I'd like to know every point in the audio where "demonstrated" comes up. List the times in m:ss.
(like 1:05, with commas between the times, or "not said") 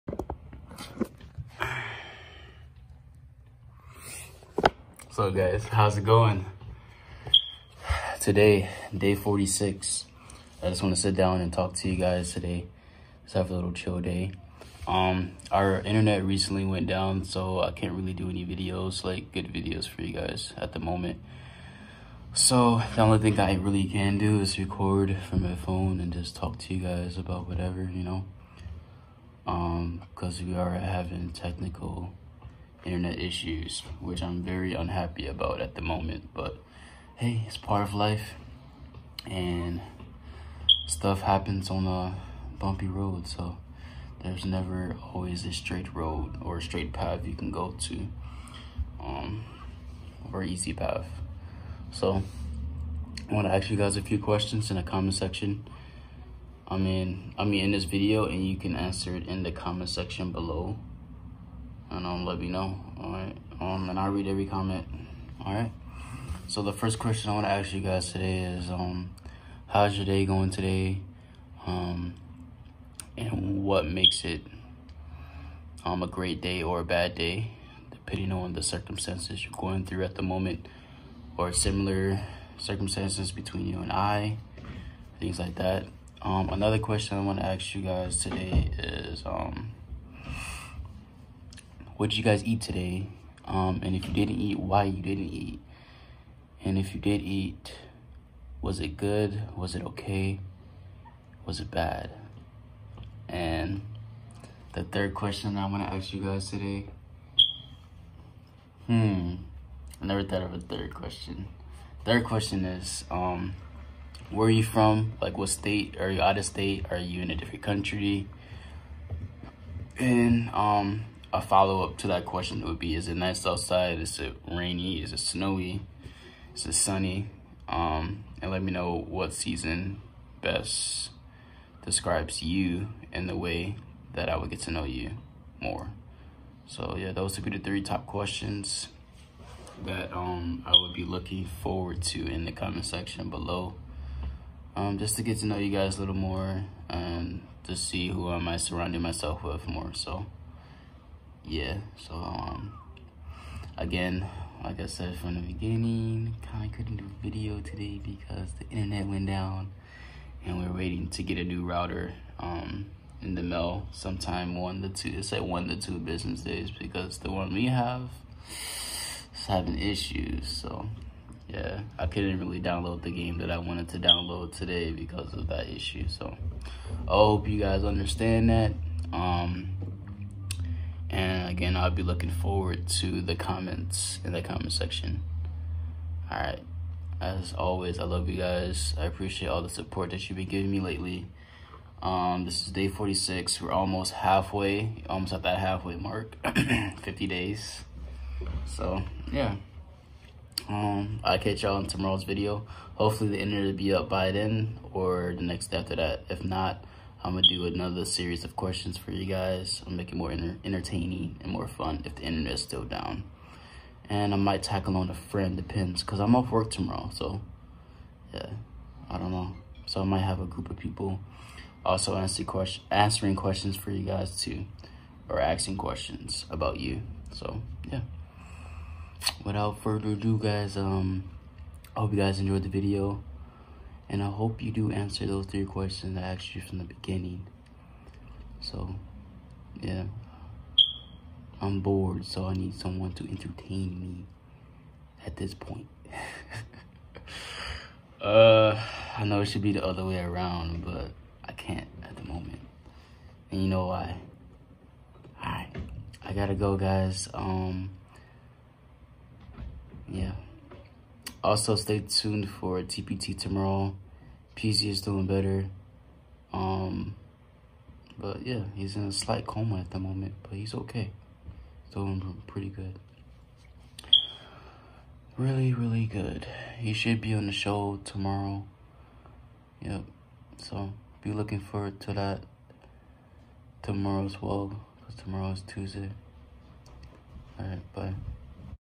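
not said.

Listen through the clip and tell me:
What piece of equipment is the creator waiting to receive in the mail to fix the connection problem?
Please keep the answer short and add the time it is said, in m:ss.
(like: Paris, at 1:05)
a new router, at 2:41.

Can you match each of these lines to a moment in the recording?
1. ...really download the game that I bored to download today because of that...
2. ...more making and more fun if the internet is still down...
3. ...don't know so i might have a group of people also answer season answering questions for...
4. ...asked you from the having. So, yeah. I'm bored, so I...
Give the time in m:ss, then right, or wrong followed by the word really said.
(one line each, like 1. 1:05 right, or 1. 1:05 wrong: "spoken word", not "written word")
1. 2:52 wrong: "wanted", not "bored"
2. 3:30 wrong: "entertaining", not "making"
3. 3:39 wrong: "question", not "season"
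4. 3:56 wrong: "beginning", not "having".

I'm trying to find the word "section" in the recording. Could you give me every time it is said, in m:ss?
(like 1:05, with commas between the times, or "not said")
0:55, 0:59, 2:22, 3:04.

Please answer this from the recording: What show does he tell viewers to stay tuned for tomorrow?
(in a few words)
TPT.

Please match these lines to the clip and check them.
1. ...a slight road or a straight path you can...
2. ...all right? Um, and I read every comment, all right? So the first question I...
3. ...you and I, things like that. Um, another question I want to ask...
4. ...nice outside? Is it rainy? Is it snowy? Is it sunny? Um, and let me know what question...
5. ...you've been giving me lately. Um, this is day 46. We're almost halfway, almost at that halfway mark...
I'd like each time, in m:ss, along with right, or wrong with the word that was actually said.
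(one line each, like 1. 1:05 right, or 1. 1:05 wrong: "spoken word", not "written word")
1. 0:45 wrong: "straight", not "slight"
2. 1:02 right
3. 1:23 right
4. 2:03 wrong: "season", not "question"
5. 3:10 right.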